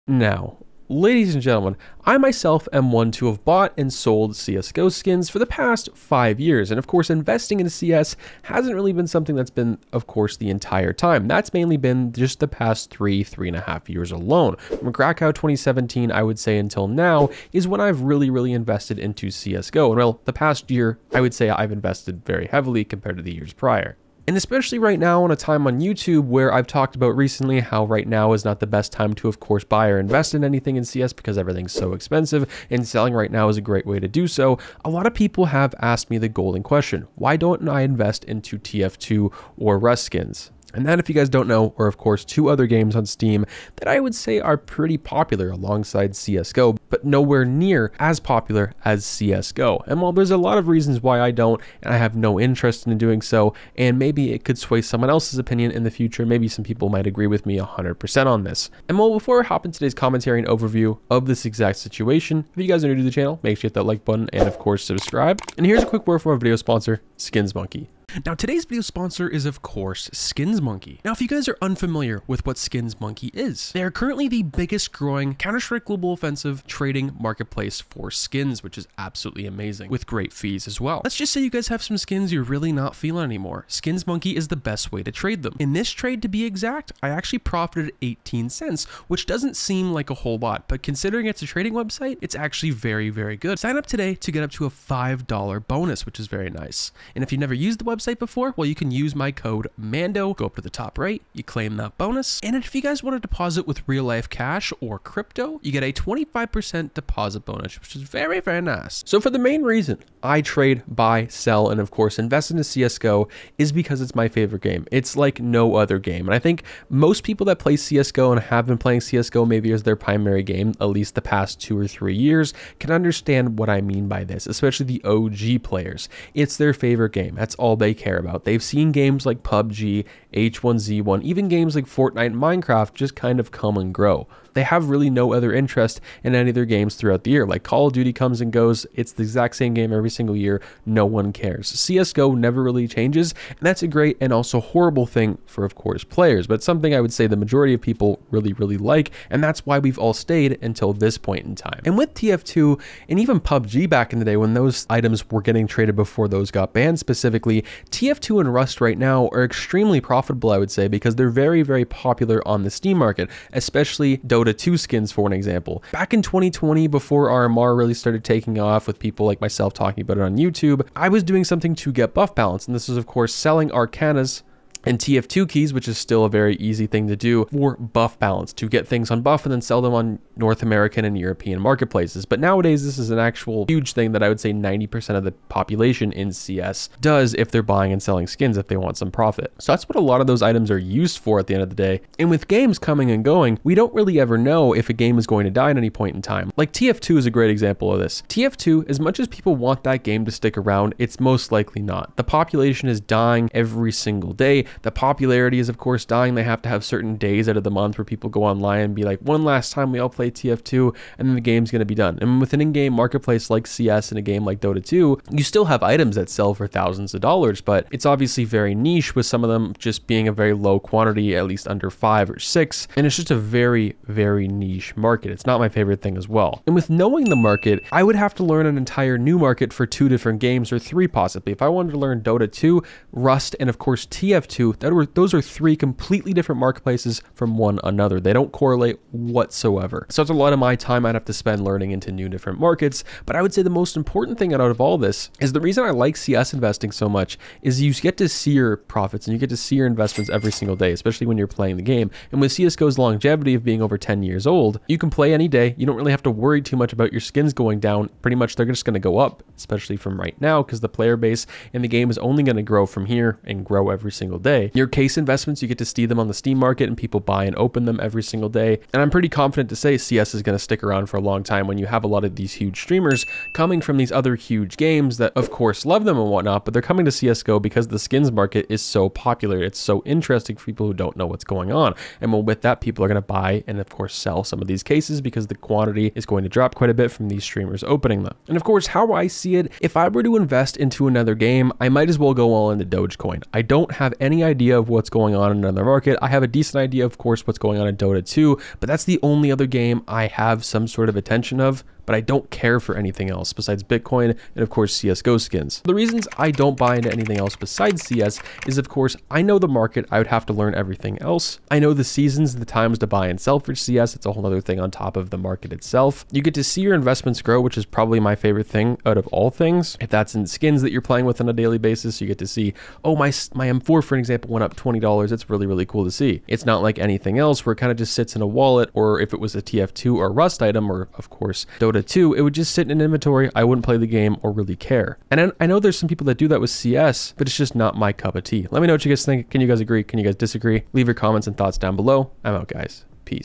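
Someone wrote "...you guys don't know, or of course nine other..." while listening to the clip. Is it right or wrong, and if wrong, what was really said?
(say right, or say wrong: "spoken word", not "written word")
wrong: "two", not "nine".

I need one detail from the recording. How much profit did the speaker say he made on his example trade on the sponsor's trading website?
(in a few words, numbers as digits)
18 cents.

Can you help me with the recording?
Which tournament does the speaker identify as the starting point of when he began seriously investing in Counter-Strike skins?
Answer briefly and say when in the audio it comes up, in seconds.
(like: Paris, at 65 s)
Krakow 2017, at 14 s.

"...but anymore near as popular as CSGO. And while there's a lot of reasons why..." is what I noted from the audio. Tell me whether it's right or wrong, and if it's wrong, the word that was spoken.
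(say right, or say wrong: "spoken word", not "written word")
wrong: "nowhere", not "anymore".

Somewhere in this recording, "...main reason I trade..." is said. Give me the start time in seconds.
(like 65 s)
109 s.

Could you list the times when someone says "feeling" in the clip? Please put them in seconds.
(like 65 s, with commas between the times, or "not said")
82 s.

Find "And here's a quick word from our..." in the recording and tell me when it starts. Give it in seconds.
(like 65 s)
65 s.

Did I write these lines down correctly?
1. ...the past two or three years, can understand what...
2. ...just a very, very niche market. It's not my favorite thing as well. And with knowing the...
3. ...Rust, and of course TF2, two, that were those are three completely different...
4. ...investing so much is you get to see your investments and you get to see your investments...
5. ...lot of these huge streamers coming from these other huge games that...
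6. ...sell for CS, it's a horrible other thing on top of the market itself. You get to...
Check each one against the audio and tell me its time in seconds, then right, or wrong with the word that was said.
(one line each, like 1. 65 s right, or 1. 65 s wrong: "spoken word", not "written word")
1. 121 s right
2. 223 s right
3. 233 s right
4. 246 s wrong: "profits", not "investments"
5. 272 s right
6. 313 s wrong: "whole", not "horrible".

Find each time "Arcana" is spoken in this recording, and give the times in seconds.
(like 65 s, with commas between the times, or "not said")
173 s.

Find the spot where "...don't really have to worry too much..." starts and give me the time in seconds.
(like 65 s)
255 s.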